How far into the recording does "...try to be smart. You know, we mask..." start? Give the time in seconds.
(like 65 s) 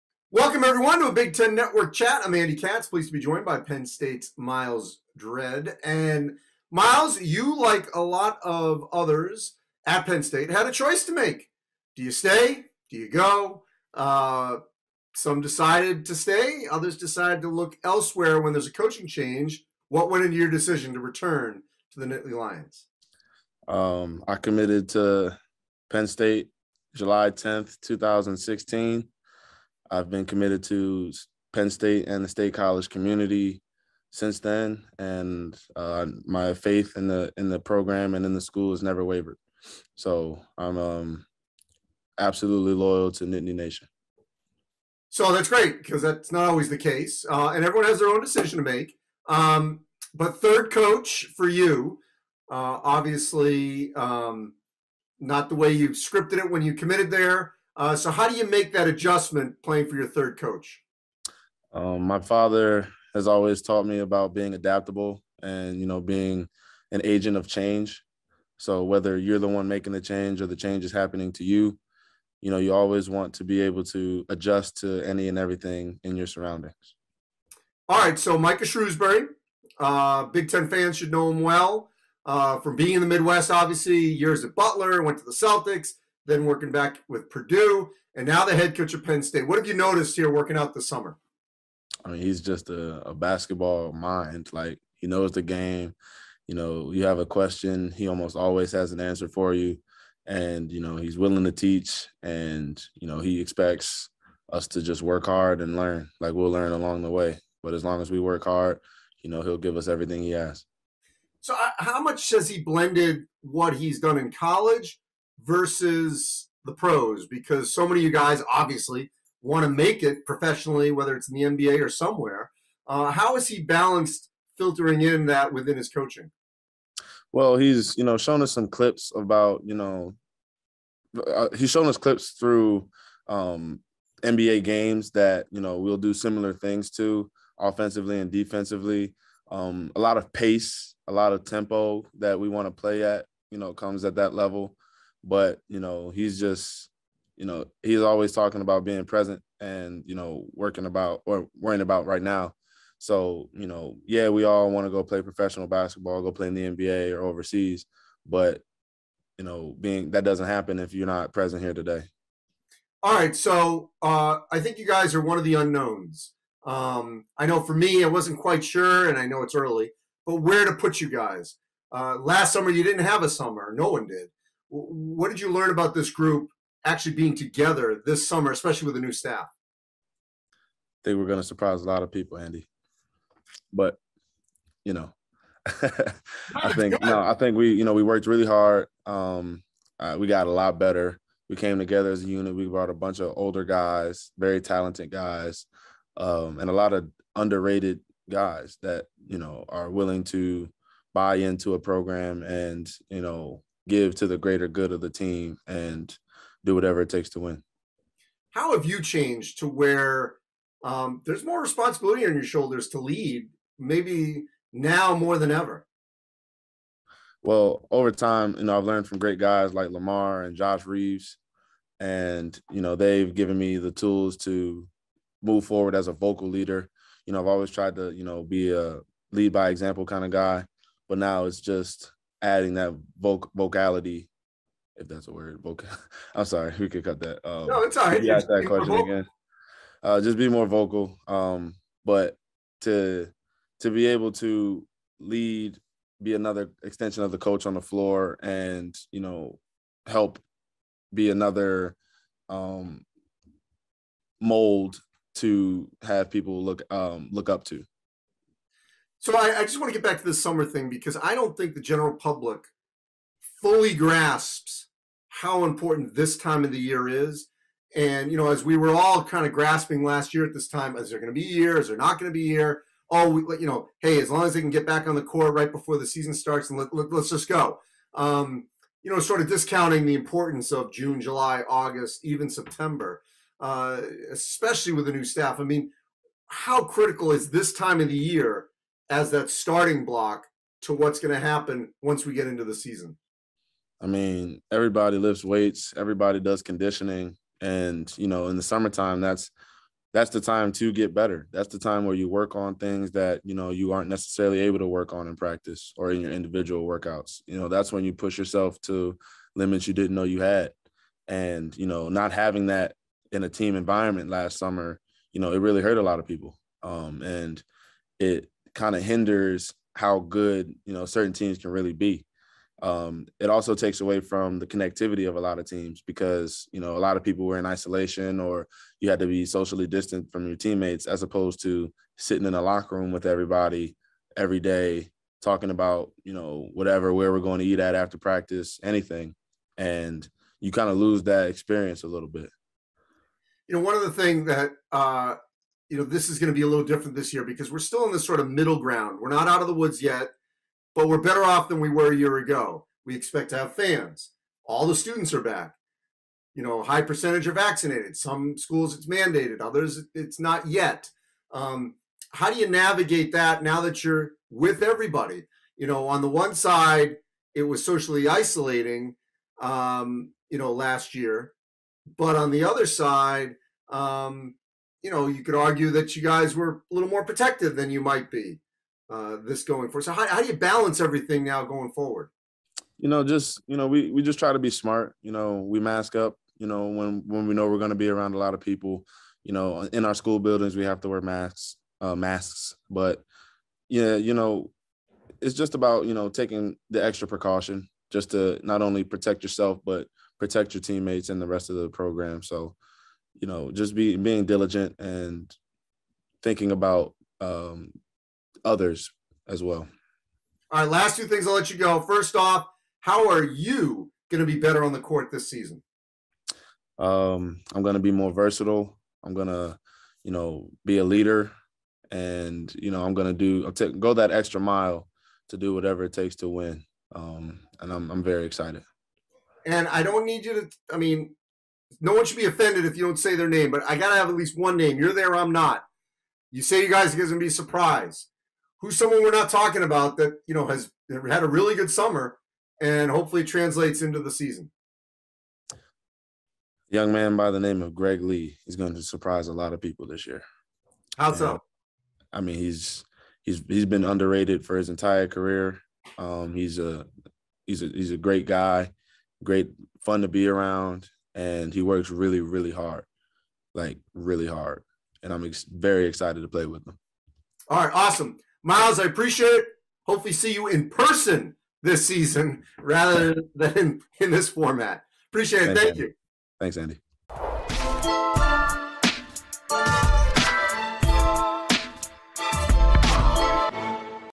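384 s.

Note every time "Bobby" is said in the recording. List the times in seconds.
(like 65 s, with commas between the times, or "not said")
not said.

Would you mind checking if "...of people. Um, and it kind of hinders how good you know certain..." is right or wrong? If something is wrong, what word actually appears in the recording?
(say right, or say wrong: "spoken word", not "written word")
right.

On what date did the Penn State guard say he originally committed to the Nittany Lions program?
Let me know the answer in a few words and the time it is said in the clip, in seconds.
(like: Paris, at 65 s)
July 10th, 2016, at 26 s.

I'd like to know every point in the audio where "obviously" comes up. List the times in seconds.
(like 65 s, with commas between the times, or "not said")
52 s, 83 s, 118 s.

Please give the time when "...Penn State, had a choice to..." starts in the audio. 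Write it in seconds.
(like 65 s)
10 s.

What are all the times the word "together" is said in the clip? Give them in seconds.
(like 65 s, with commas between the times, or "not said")
177 s, 191 s.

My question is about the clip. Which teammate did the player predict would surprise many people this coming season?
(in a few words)
Greg Lee.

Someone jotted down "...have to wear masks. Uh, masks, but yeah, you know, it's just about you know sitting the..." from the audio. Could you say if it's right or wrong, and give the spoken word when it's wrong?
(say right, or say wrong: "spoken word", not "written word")
wrong: "taking", not "sitting".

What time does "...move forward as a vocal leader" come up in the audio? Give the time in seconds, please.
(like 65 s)
225 s.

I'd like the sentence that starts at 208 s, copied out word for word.
How have you changed to where um, there's more responsibility on your shoulders to lead, maybe now more than ever?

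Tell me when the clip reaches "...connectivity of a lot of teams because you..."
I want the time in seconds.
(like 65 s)
324 s.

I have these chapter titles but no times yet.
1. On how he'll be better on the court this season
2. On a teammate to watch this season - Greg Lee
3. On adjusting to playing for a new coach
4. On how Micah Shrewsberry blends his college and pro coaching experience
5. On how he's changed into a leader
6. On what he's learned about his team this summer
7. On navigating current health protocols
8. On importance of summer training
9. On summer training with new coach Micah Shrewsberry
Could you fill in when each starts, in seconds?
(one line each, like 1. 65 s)
1. 411 s
2. 430 s
3. 44 s
4. 112 s
5. 211 s
6. 163 s
7. 345 s
8. 260 s
9. 78 s.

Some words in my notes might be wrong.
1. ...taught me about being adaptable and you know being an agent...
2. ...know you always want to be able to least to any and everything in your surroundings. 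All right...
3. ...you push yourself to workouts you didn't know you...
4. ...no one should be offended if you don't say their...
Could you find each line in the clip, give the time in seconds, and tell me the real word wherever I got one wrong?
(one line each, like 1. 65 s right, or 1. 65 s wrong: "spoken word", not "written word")
1. 63 s right
2. 72 s wrong: "adjust", not "least"
3. 308 s wrong: "limits", not "workouts"
4. 431 s right.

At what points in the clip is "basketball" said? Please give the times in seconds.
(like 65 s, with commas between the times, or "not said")
93 s, 155 s.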